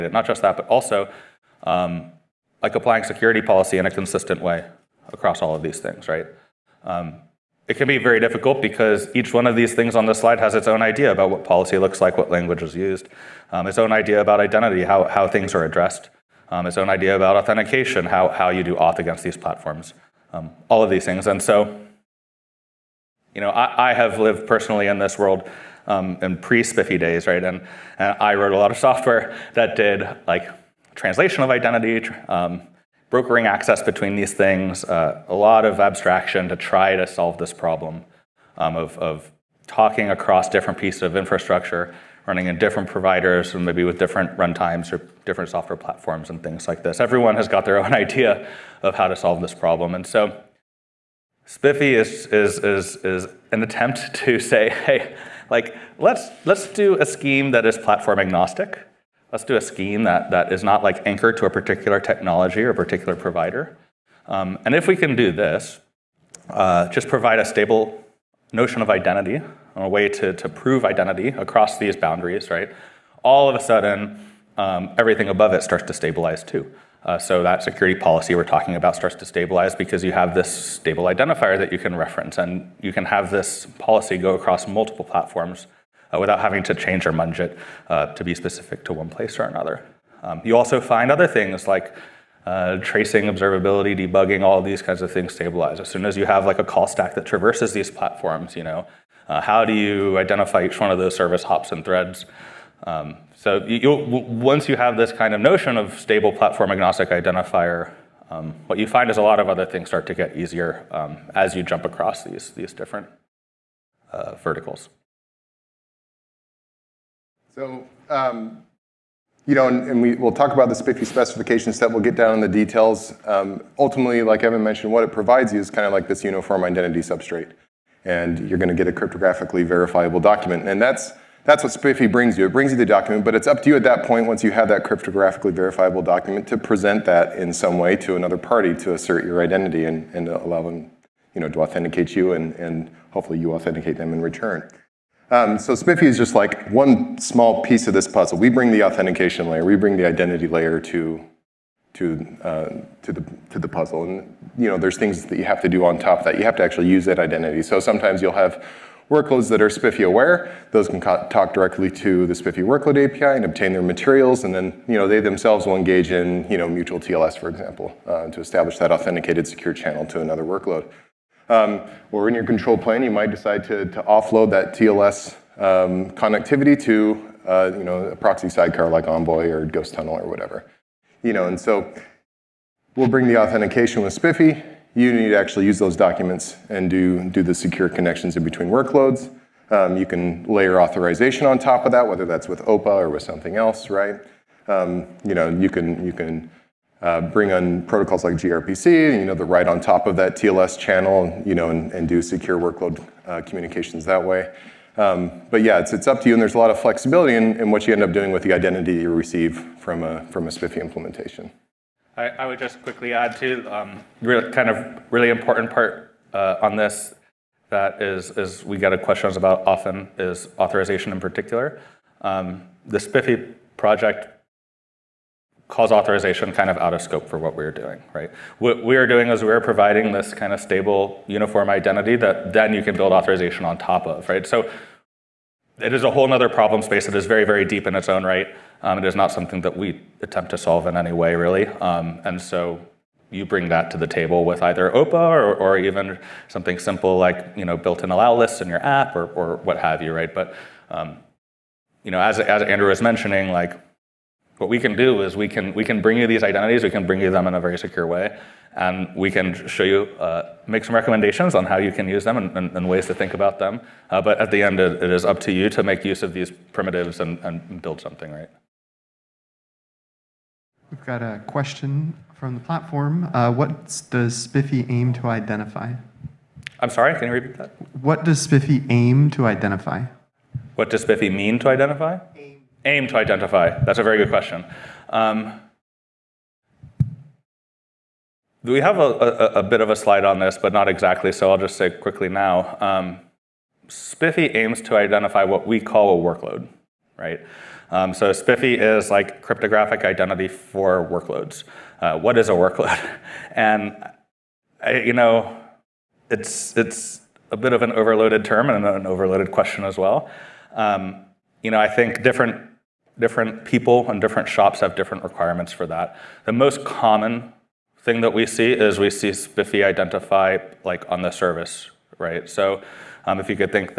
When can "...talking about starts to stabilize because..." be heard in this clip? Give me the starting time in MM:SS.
01:18.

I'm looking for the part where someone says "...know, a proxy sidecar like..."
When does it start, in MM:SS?
02:57.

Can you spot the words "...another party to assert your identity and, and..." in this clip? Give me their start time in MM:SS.
02:18.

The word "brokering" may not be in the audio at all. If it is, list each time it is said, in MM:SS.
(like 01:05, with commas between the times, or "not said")
00:33.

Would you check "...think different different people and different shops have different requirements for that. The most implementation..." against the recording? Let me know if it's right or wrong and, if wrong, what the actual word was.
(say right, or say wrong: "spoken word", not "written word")
wrong: "common", not "implementation".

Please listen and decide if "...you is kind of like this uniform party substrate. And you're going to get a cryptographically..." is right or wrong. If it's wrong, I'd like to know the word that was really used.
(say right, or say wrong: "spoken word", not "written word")
wrong: "identity", not "party".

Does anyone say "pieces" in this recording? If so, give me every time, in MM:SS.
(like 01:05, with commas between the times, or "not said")
00:40, 02:27.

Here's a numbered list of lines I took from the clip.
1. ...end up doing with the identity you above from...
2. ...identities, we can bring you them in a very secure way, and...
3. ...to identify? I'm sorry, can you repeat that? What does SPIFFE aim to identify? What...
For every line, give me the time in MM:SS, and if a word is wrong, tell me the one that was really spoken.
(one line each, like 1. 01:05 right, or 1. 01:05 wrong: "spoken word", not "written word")
1. 03:27 wrong: "receive", not "above"
2. 04:16 right
3. 04:35 right.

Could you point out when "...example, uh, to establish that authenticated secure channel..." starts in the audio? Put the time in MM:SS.
02:47.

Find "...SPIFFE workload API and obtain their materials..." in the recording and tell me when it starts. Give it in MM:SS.
02:42.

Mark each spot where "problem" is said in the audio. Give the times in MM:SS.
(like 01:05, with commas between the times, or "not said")
00:37, 00:49, 03:56.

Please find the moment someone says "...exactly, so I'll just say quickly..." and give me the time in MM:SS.
04:50.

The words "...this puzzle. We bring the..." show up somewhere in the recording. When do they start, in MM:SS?
02:27.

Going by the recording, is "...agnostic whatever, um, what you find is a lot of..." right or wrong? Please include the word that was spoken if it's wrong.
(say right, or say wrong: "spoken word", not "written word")
wrong: "identifier", not "whatever".